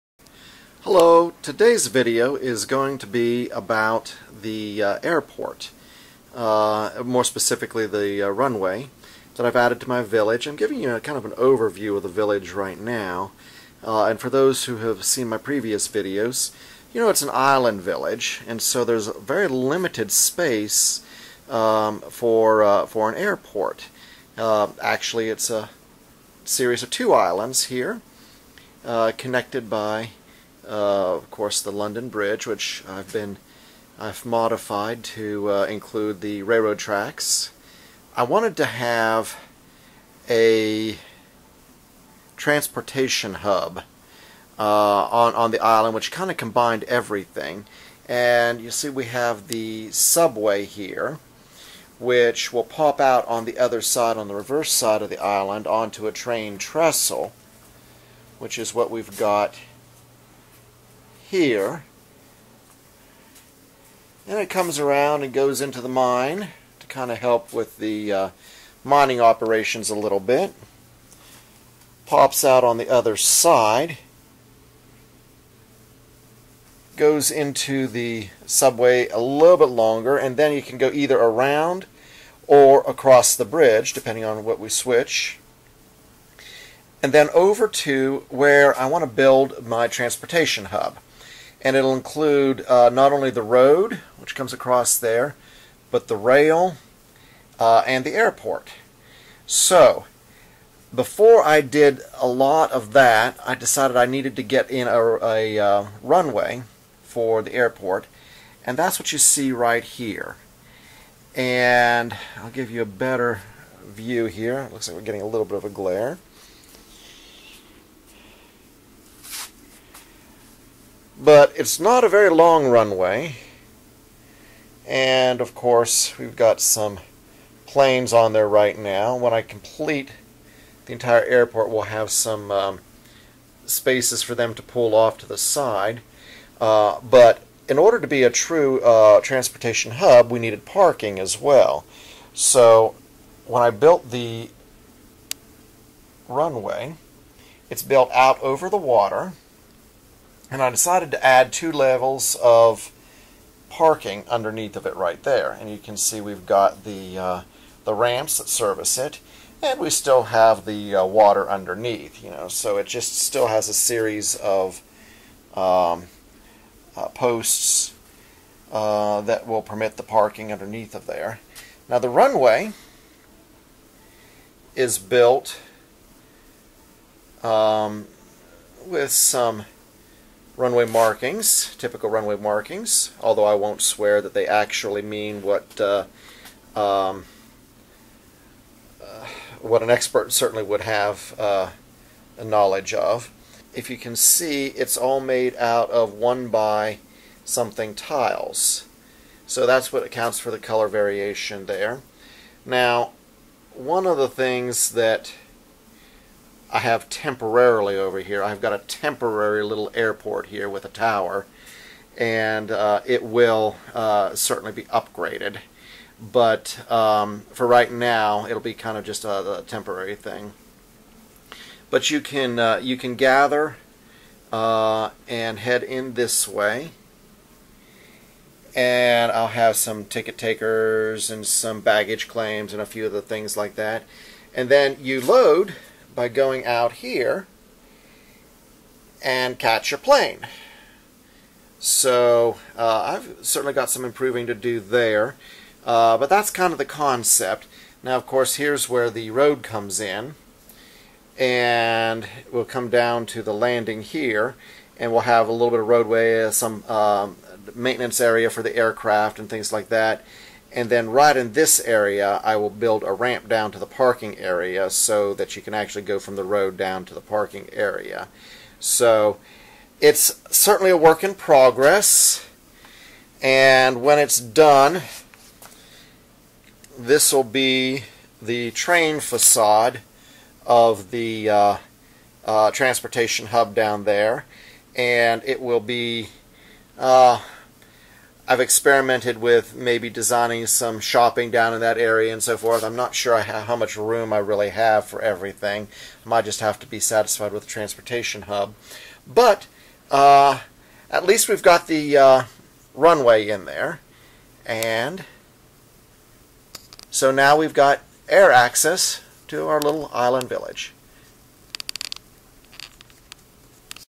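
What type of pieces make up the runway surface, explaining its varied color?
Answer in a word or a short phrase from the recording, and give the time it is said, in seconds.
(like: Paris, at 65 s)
One by something tiles, at 196 s.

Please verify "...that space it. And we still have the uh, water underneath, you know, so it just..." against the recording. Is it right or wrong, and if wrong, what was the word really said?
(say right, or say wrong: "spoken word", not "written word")
wrong: "service", not "space".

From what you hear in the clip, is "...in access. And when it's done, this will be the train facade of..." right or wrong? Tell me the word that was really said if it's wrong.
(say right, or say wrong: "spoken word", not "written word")
wrong: "progress", not "access".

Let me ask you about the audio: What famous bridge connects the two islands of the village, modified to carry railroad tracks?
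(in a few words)
London Bridge.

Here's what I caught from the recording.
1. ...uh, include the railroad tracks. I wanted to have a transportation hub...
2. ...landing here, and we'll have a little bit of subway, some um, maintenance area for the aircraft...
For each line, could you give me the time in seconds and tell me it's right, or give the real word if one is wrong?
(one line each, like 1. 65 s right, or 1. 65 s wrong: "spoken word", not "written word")
1. 35 s right
2. 253 s wrong: "roadway", not "subway".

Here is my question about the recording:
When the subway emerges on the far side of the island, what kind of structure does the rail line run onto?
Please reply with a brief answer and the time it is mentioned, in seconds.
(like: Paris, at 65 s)
A train trestle, at 56 s.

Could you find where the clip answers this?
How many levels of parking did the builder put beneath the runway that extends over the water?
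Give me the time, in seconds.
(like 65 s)
151 s.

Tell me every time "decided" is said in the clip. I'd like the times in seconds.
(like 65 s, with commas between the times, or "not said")
103 s, 150 s.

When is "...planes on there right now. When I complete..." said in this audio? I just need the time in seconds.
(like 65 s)
127 s.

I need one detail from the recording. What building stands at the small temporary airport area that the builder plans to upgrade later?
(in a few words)
A tower.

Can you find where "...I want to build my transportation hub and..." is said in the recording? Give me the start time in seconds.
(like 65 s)
88 s.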